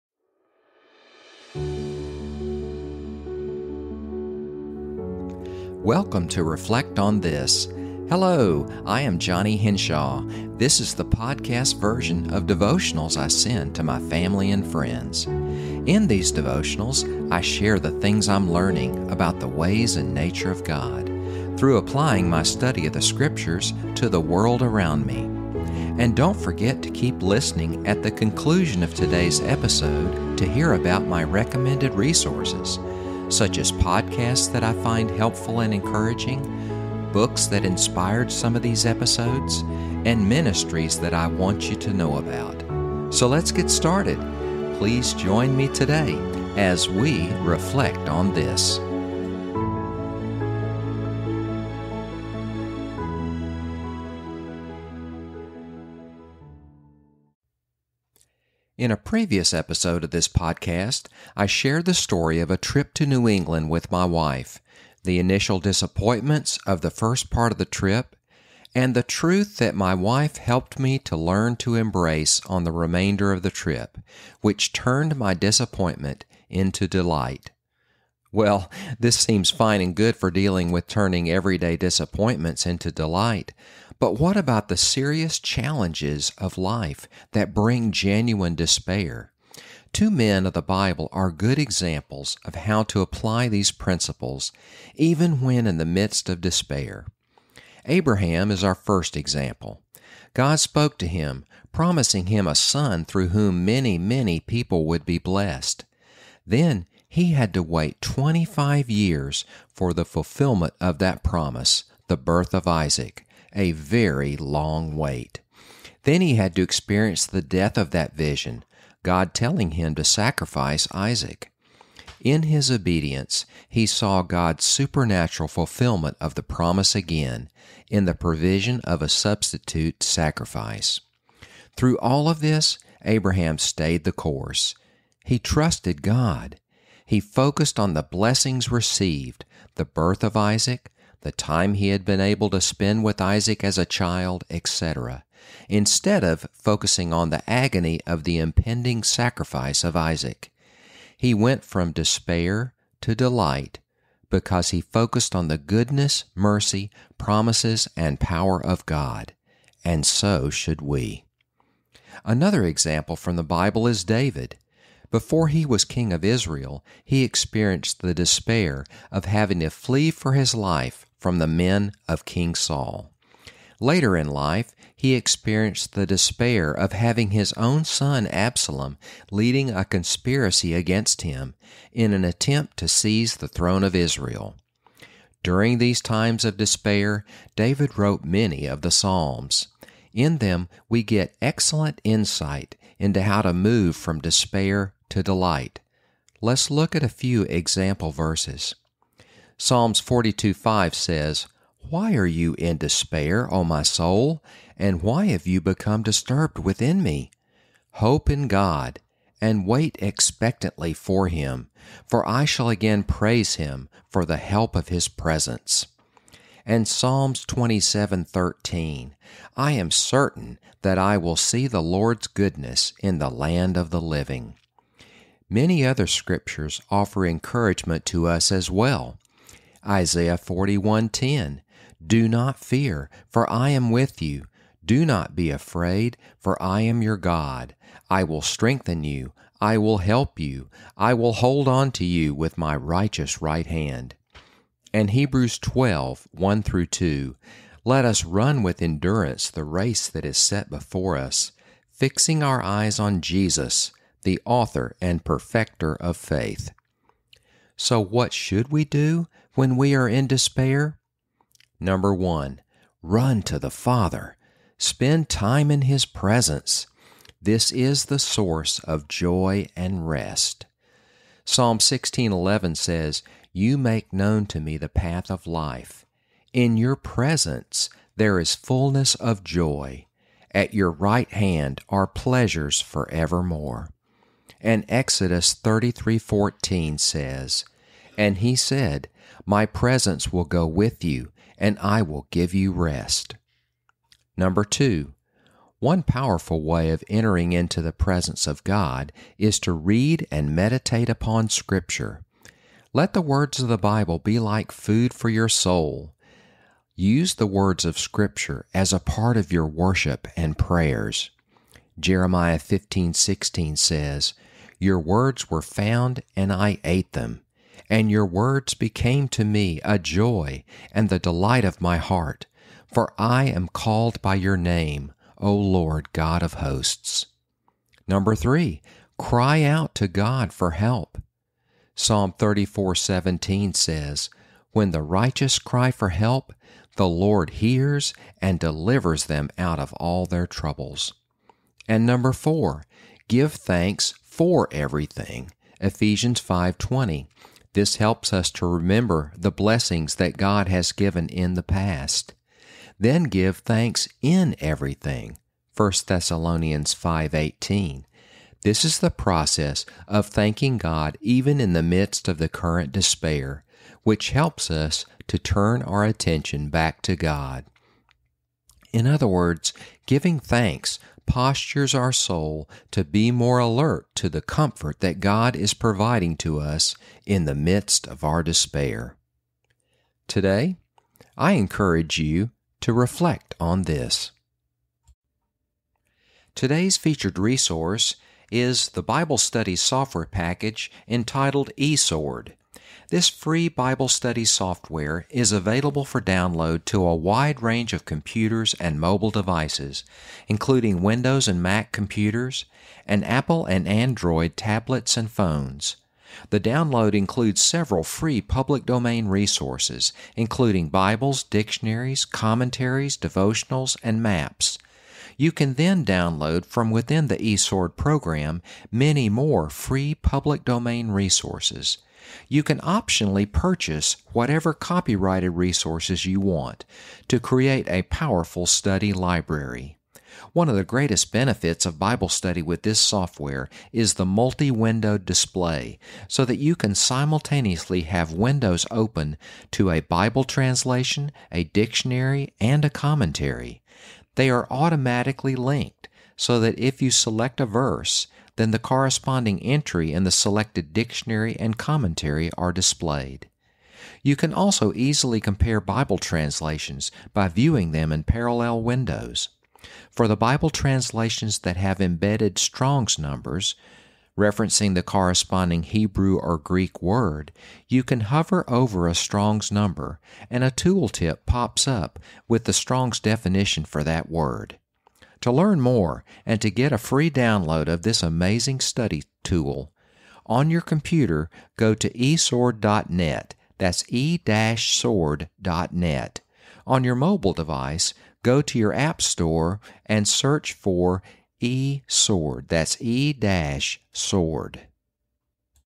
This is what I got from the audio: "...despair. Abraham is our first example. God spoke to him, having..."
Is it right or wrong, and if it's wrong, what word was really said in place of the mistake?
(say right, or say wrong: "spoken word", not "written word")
wrong: "promising", not "having".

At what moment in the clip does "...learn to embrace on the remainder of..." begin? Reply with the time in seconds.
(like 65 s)
71 s.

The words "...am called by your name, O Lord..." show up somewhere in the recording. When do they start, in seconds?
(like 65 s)
323 s.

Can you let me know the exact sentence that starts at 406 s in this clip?
The download includes several free public domain resources, including Bibles, dictionaries, commentaries, devotionals, and maps.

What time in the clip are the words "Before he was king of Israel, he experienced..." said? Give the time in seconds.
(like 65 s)
165 s.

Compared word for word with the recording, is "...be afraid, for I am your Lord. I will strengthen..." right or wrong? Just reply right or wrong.
wrong.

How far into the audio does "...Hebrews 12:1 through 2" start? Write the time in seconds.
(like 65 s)
245 s.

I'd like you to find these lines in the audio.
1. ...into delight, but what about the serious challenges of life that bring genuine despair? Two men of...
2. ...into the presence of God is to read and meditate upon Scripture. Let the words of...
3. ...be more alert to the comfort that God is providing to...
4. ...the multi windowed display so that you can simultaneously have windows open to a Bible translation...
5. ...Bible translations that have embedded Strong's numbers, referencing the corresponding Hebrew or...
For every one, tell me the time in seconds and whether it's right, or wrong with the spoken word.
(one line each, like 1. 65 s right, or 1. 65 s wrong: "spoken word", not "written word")
1. 82 s right
2. 297 s right
3. 373 s right
4. 434 s right
5. 460 s right.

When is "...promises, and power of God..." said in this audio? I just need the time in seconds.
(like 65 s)
157 s.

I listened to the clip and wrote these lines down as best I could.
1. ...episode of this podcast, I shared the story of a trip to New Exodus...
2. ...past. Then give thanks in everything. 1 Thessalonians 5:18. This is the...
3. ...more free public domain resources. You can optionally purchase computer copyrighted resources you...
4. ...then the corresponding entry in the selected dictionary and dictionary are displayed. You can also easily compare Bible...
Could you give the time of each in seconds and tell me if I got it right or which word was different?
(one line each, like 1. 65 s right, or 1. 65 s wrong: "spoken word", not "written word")
1. 59 s wrong: "England", not "Exodus"
2. 351 s right
3. 419 s wrong: "whatever", not "computer"
4. 448 s wrong: "commentary", not "dictionary".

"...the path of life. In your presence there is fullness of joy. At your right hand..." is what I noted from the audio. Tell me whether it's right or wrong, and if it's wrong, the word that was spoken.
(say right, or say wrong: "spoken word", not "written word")
right.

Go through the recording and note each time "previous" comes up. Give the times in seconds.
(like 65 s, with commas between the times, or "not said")
58 s.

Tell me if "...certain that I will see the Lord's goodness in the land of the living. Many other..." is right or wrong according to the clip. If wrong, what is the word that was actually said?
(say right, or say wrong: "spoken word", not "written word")
right.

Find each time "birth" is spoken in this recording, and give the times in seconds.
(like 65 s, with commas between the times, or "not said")
112 s, 139 s.